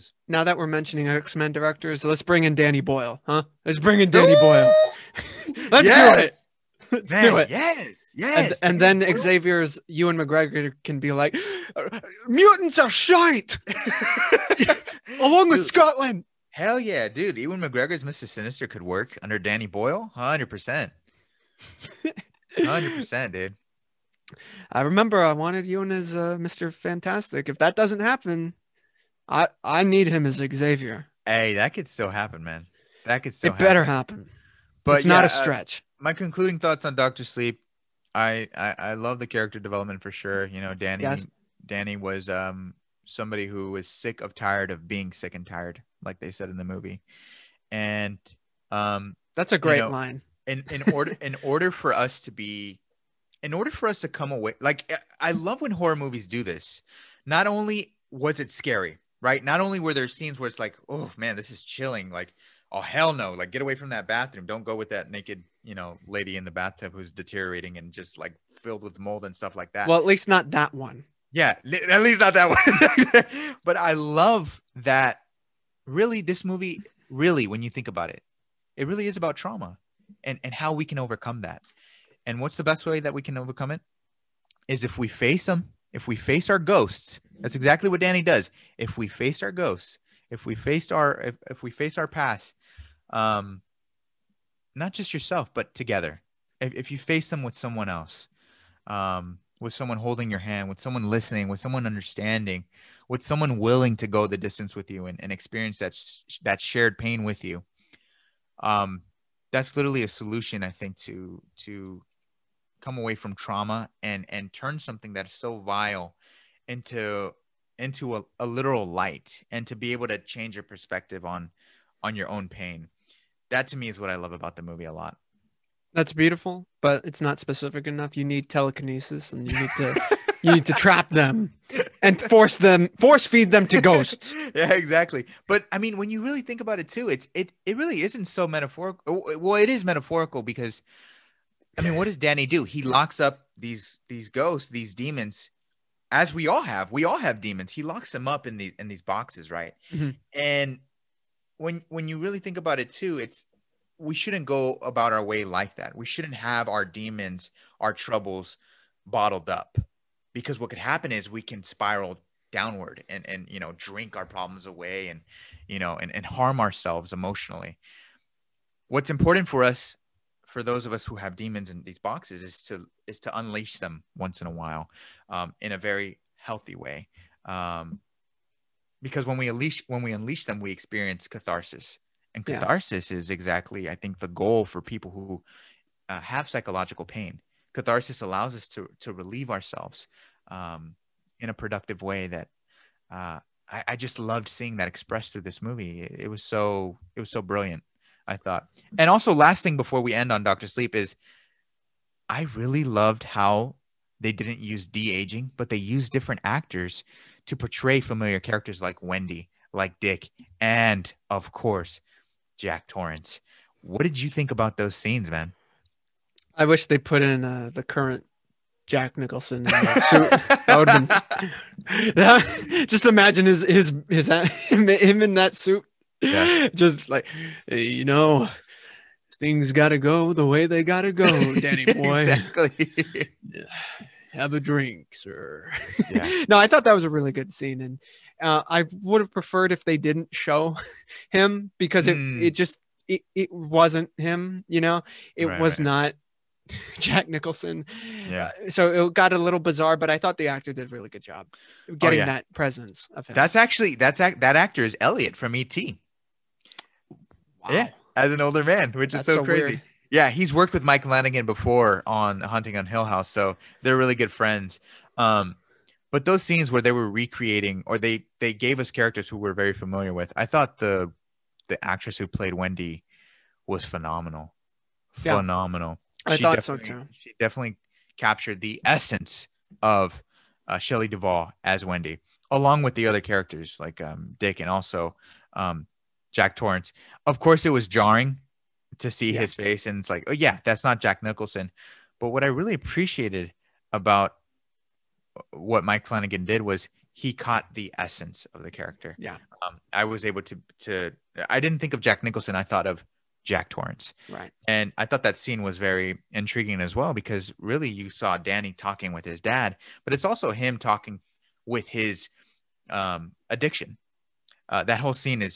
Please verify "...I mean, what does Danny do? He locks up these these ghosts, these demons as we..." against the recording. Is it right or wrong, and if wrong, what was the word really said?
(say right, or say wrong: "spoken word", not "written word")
right.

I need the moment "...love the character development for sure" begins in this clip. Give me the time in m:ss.
0:38.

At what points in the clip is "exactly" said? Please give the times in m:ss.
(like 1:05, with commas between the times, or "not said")
1:27, 2:14, 3:03, 3:52.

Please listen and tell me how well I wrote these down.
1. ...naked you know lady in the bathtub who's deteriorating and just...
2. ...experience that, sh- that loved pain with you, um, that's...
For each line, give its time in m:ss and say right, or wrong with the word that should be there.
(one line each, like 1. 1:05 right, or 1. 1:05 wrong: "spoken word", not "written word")
1. 1:05 right
2. 1:45 wrong: "shared", not "loved".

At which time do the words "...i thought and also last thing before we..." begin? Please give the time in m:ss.
3:18.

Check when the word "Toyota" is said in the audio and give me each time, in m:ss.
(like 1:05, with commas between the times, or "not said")
not said.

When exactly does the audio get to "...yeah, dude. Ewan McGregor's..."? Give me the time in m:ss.
0:16.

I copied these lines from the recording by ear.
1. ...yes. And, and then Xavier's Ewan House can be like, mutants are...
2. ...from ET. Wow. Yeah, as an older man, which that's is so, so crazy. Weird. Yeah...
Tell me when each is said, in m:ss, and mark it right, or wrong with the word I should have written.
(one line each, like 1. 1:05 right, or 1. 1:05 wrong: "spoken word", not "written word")
1. 0:08 wrong: "McGregor", not "House"
2. 4:15 right.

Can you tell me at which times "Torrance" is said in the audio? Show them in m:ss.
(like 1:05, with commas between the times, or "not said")
3:32, 4:46, 5:03.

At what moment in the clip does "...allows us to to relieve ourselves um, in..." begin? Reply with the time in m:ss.
3:08.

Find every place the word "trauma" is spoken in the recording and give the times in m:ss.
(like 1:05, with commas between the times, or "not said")
1:19, 1:53.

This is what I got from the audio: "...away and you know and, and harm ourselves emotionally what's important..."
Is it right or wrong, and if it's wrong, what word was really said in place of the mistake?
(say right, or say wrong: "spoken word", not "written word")
right.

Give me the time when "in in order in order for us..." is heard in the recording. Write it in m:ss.
0:50.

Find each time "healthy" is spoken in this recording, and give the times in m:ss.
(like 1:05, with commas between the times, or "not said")
2:56.